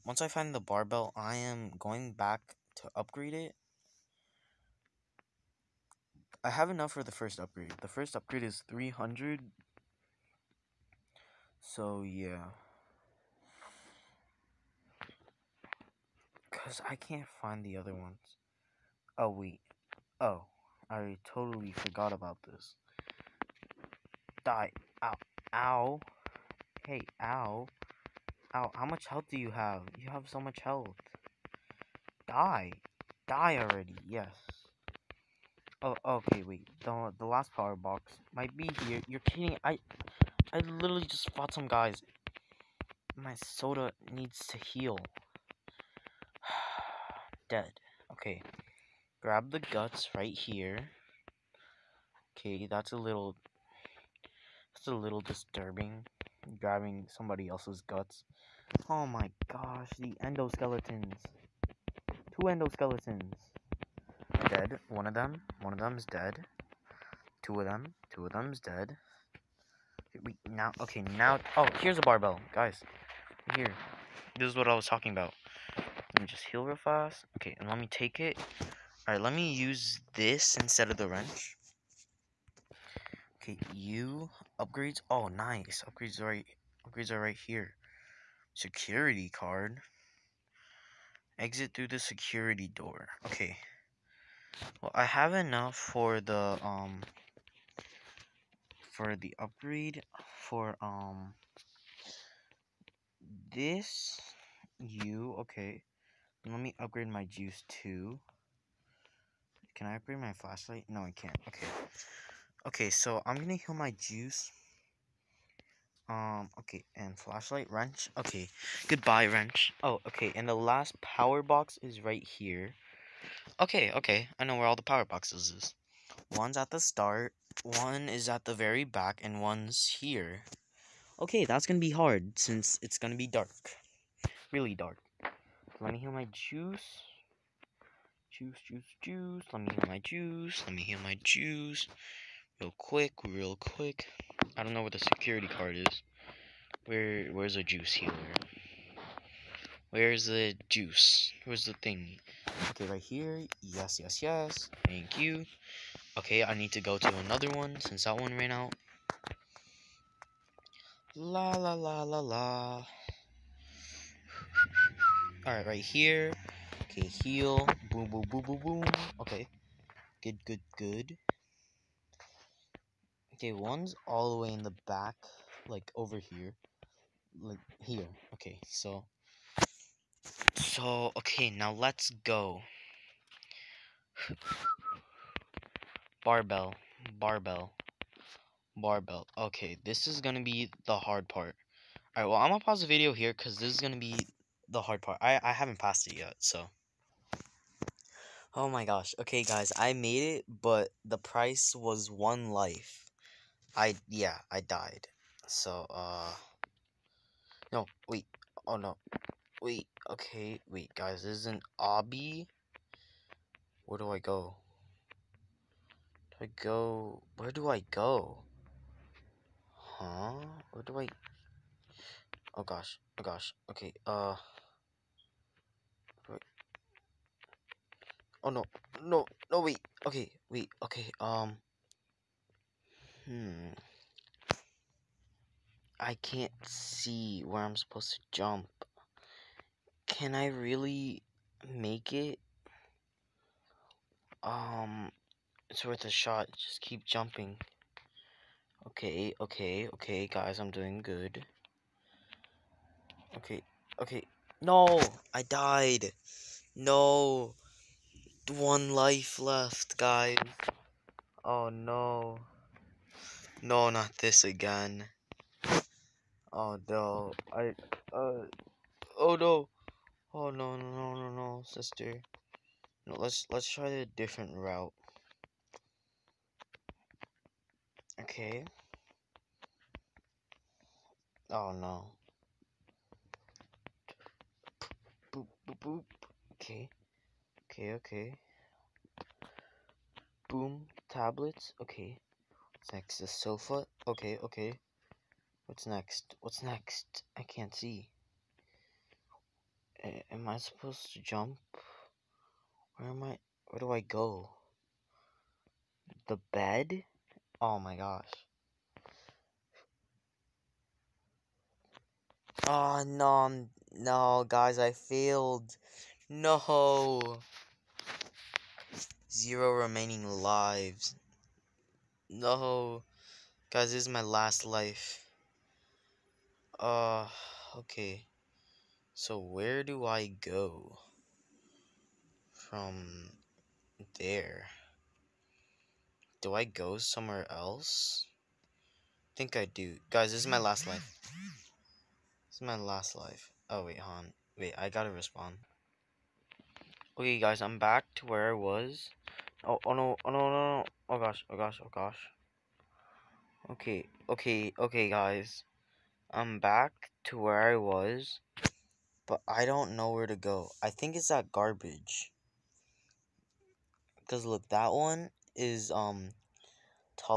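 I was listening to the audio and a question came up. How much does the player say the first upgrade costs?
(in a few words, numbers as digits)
300.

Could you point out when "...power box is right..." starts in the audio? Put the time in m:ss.
2:01.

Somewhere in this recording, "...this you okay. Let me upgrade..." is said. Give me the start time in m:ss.
1:43.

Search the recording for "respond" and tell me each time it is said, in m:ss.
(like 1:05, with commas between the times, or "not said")
5:45.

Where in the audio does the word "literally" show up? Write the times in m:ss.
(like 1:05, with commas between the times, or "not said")
0:40.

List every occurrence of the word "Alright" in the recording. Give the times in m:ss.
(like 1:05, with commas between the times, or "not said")
1:19, 2:45, 3:12.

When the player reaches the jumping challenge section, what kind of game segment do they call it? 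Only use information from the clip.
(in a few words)
Obby.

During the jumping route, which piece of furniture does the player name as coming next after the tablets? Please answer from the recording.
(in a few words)
Sofa.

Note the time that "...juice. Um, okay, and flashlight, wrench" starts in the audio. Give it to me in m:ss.
1:53.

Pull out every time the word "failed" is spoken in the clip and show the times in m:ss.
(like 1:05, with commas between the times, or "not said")
5:14.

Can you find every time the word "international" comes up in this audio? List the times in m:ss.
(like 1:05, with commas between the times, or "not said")
not said.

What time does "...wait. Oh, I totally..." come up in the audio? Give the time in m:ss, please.
0:19.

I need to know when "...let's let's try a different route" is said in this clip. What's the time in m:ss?
4:33.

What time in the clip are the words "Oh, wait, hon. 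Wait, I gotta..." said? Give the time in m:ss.
5:43.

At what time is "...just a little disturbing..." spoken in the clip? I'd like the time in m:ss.
0:54.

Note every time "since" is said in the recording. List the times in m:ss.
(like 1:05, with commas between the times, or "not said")
2:12, 2:37.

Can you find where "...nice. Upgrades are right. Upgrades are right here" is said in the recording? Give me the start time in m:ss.
1:25.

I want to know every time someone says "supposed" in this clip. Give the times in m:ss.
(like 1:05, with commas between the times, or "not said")
3:57, 5:00.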